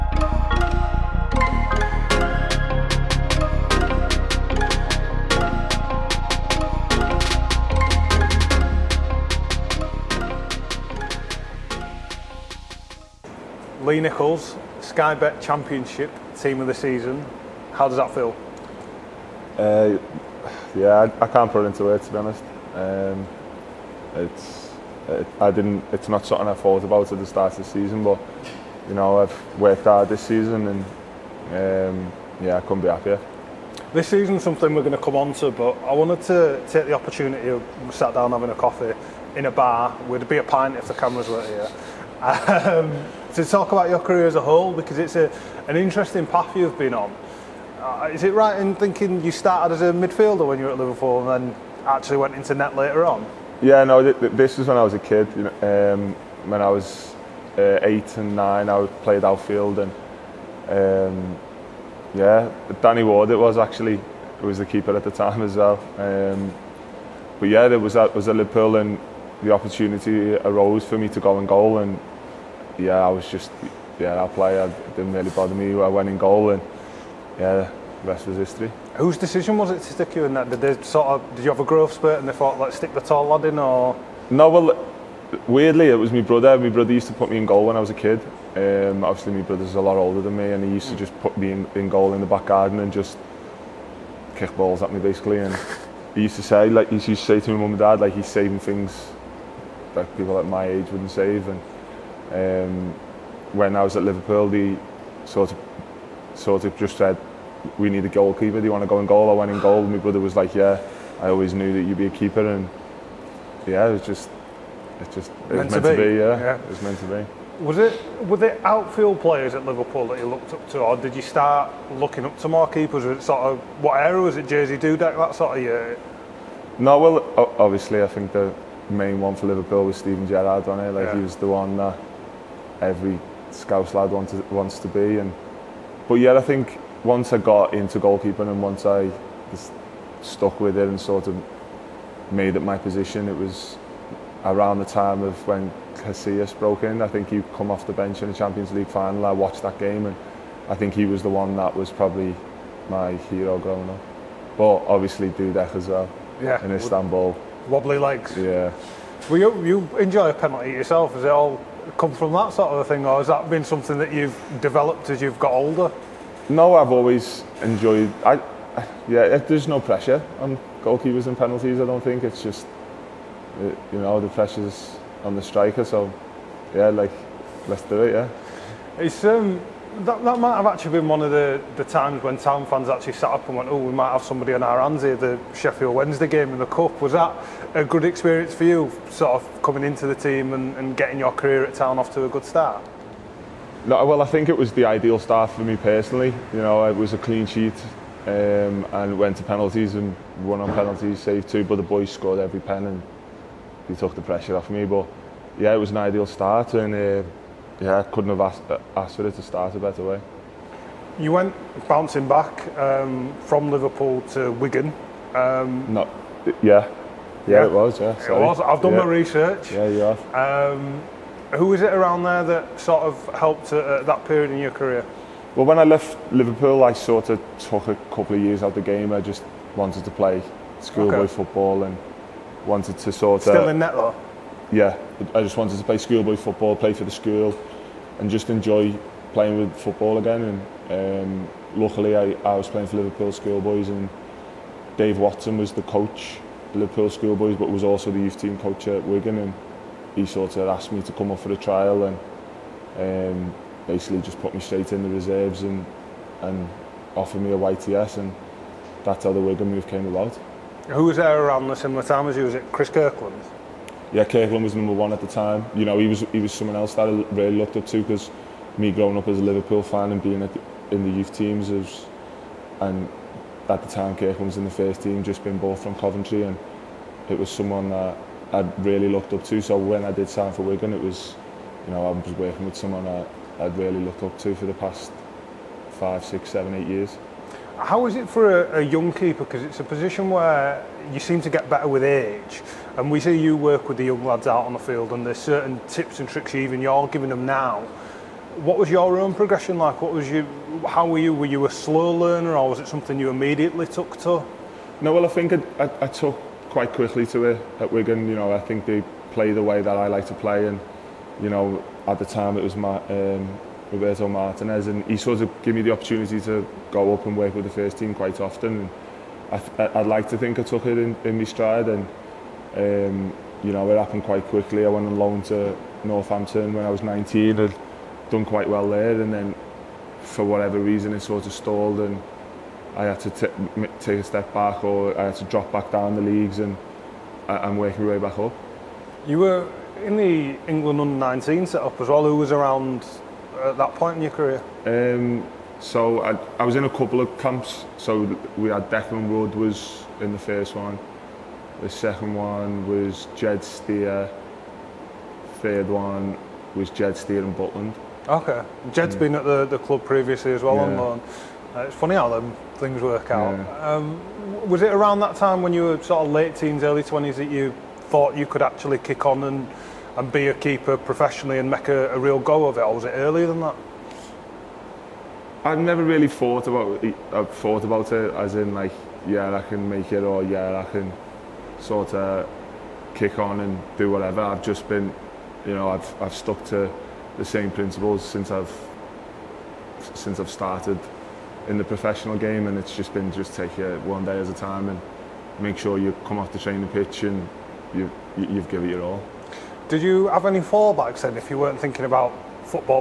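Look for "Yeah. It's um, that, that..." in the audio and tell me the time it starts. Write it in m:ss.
2:58.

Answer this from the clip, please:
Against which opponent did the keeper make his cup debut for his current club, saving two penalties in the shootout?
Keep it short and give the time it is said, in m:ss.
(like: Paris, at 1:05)
Sheffield Wednesday, at 3:05.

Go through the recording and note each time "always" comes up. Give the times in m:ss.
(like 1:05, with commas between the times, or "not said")
1:51, 2:46.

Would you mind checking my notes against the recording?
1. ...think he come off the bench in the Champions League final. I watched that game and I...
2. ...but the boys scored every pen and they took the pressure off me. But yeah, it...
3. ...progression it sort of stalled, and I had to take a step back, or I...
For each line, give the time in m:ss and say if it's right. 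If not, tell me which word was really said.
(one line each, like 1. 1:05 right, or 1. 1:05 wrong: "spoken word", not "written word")
1. 2:27 right
2. 3:21 right
3. 5:30 wrong: "reason", not "progression".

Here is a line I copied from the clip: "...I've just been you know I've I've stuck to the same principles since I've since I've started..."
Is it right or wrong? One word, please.
right.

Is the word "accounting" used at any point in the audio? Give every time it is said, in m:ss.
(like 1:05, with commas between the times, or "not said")
not said.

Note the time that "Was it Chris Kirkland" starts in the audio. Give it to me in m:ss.
4:22.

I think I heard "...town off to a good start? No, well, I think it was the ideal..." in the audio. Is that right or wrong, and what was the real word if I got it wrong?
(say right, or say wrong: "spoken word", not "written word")
right.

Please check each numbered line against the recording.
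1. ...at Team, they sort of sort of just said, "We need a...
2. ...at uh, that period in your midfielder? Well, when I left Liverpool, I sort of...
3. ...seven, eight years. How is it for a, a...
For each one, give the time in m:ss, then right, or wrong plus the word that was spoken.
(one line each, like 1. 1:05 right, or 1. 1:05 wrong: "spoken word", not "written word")
1. 1:43 wrong: "Liverpool", not "Team"
2. 3:43 wrong: "career", not "midfielder"
3. 4:46 right.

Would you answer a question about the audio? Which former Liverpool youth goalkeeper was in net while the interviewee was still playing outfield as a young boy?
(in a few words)
Danny Ward.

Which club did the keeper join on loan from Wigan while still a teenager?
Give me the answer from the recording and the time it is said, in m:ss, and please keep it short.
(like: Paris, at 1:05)
Northampton, at 5:26.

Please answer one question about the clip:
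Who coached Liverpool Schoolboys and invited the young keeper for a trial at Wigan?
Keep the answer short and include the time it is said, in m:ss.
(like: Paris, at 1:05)
Dave Watson, at 4:04.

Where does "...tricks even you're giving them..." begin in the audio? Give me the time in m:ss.
4:56.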